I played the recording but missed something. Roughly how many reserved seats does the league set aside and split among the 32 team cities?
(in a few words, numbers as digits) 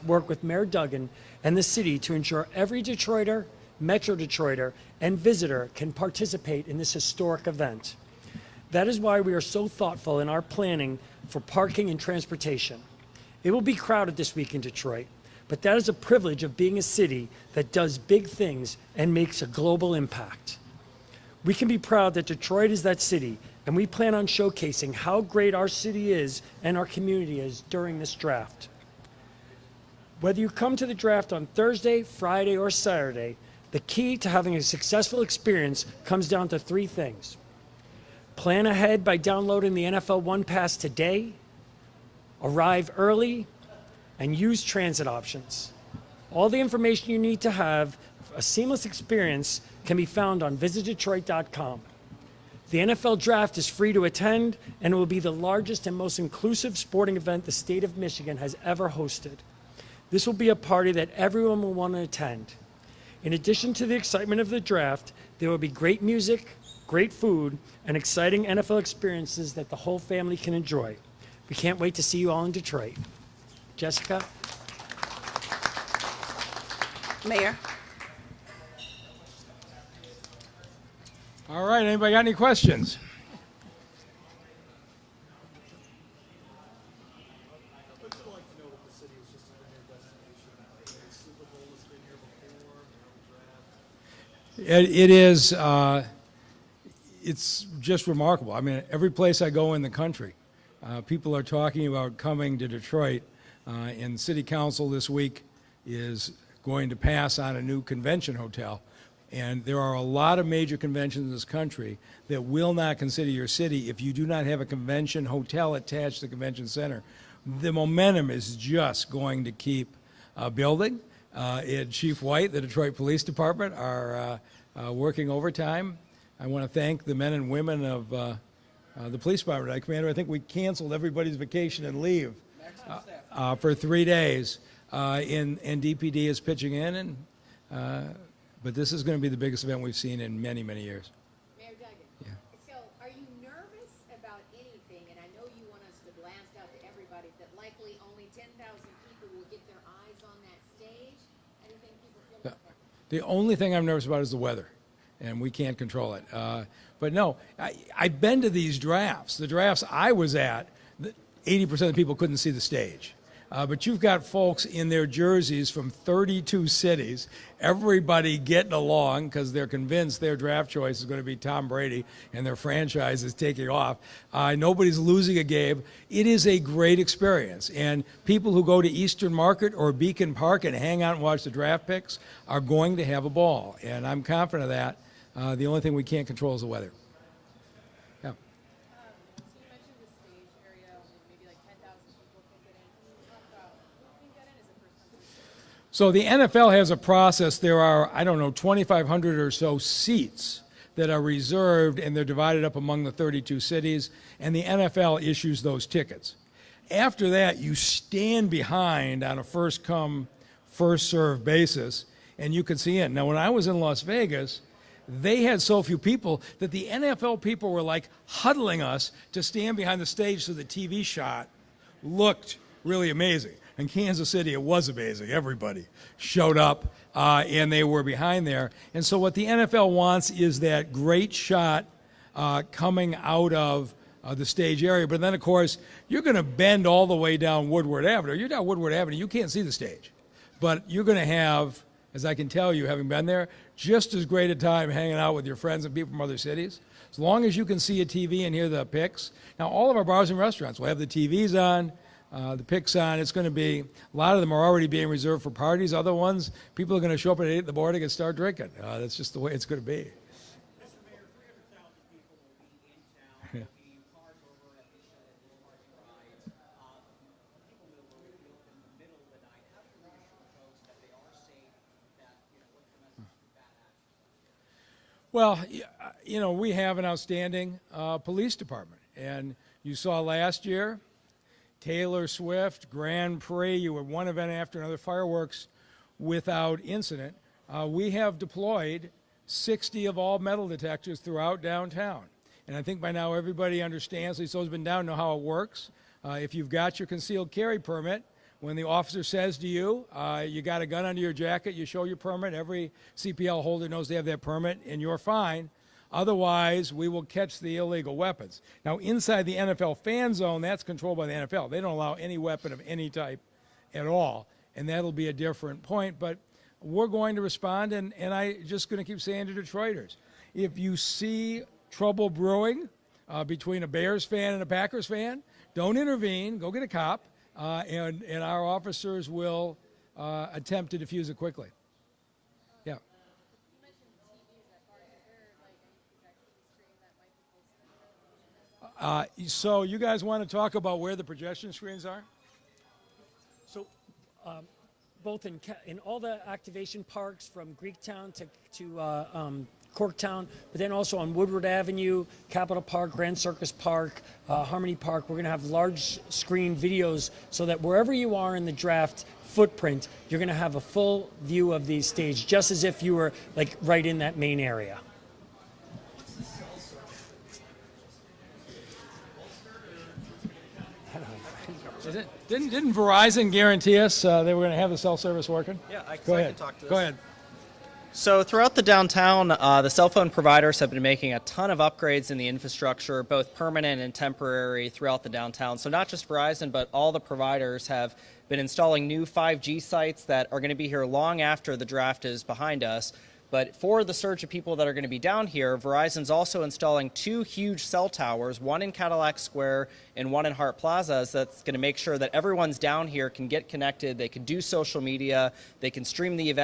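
2,500.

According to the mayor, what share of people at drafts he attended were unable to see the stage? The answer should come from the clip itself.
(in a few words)
80%.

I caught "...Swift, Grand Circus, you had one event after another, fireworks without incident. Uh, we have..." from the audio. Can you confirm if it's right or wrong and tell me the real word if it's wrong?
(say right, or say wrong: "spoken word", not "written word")
wrong: "Prix", not "Circus".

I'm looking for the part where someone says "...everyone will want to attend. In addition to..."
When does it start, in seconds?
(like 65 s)
61 s.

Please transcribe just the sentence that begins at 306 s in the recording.
Otherwise, we will catch the illegal weapons.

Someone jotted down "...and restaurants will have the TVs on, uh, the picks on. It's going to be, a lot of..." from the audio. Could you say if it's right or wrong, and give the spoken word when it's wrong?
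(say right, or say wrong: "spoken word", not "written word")
right.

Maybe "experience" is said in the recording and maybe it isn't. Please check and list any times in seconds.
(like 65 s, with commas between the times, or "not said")
35 s, 48 s, 68 s, 176 s.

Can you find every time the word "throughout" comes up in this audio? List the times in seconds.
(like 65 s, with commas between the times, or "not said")
291 s, 378 s, 384 s.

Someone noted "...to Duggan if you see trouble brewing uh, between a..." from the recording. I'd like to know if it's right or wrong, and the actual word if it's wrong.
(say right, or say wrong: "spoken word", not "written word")
wrong: "Detroiters", not "Duggan".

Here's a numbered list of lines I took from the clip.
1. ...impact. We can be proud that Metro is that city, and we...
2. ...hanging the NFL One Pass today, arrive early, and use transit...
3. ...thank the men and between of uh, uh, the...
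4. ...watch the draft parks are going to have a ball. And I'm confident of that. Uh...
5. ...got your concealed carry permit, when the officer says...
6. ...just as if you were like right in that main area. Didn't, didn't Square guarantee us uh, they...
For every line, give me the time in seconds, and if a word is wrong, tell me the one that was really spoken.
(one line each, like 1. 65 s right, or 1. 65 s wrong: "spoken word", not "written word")
1. 19 s wrong: "Detroit", not "Metro"
2. 39 s wrong: "downloading", not "hanging"
3. 126 s wrong: "women", not "between"
4. 181 s wrong: "picks", not "parks"
5. 296 s right
6. 362 s wrong: "Verizon", not "Square".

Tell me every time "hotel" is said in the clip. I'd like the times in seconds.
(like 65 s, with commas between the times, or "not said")
108 s, 115 s.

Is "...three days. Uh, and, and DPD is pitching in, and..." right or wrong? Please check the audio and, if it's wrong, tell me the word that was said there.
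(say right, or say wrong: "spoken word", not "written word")
right.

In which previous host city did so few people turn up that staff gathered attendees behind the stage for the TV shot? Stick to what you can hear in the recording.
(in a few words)
Las Vegas.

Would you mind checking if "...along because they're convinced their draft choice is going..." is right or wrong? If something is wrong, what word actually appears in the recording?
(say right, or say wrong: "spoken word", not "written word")
right.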